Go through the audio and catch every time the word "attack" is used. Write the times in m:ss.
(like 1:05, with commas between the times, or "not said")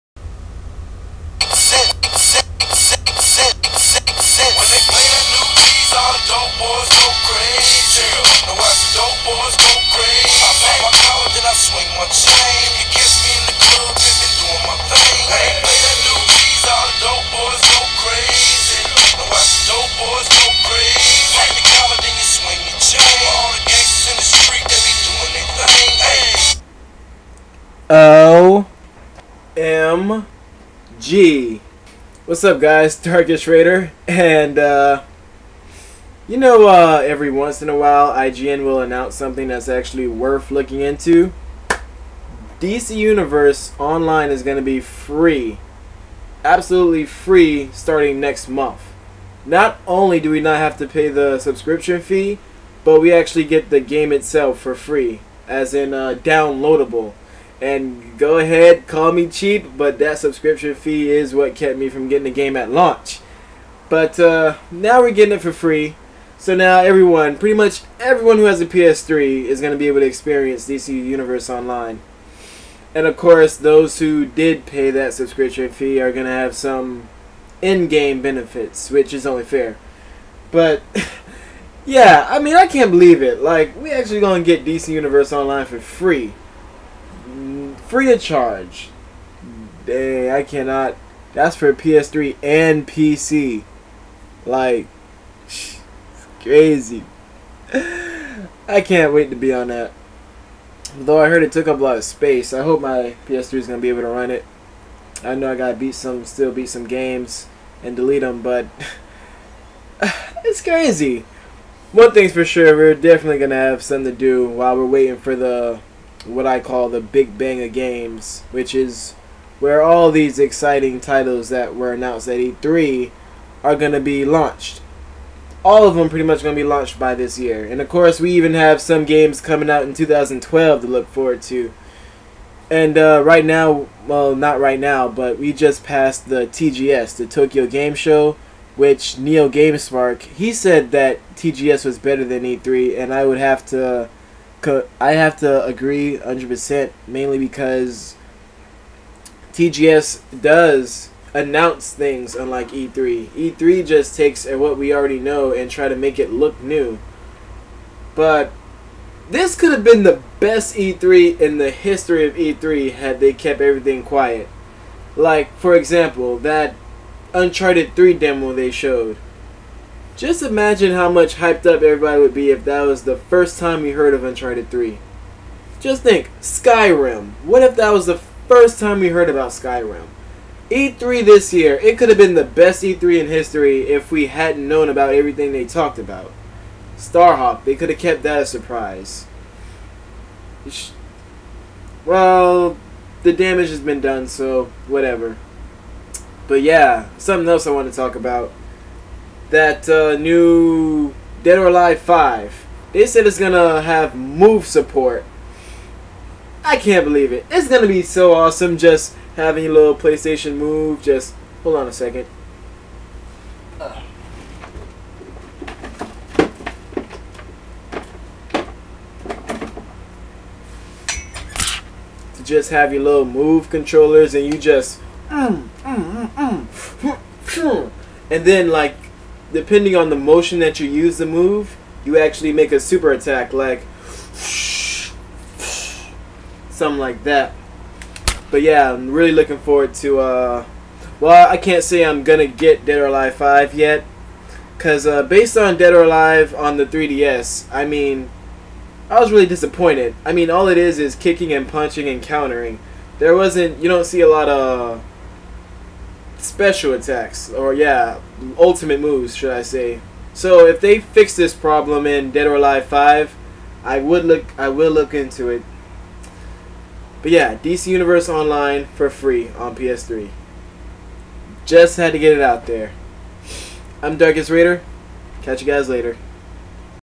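3:53, 4:16.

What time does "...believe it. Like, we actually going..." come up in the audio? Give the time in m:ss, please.
1:22.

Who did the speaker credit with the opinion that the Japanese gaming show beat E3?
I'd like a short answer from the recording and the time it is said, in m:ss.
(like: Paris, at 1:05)
Neo GameSpark, at 2:19.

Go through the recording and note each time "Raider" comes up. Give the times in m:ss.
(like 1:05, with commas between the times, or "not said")
0:33, 4:34.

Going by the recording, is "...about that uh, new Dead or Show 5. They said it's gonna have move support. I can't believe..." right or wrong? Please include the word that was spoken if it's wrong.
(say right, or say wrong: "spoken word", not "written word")
wrong: "Alive", not "Show".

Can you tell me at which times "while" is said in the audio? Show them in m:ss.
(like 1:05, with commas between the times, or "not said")
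0:37, 1:54.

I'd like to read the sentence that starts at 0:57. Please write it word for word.
And go ahead, call me cheap, but that subscription fee is what kept me from getting the game at launch.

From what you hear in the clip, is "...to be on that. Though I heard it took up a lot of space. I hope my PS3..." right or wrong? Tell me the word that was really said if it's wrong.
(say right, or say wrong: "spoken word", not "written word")
right.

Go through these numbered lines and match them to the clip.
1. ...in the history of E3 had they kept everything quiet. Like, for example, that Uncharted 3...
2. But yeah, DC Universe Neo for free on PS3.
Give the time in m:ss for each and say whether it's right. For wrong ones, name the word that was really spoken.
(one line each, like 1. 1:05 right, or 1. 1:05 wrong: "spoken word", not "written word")
1. 2:41 right
2. 4:27 wrong: "Online", not "Neo".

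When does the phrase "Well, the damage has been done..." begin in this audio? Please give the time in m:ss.
3:12.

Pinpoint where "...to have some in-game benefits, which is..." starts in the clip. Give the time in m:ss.
1:16.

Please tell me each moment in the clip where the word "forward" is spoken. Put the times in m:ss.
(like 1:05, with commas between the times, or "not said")
2:11, 3:59.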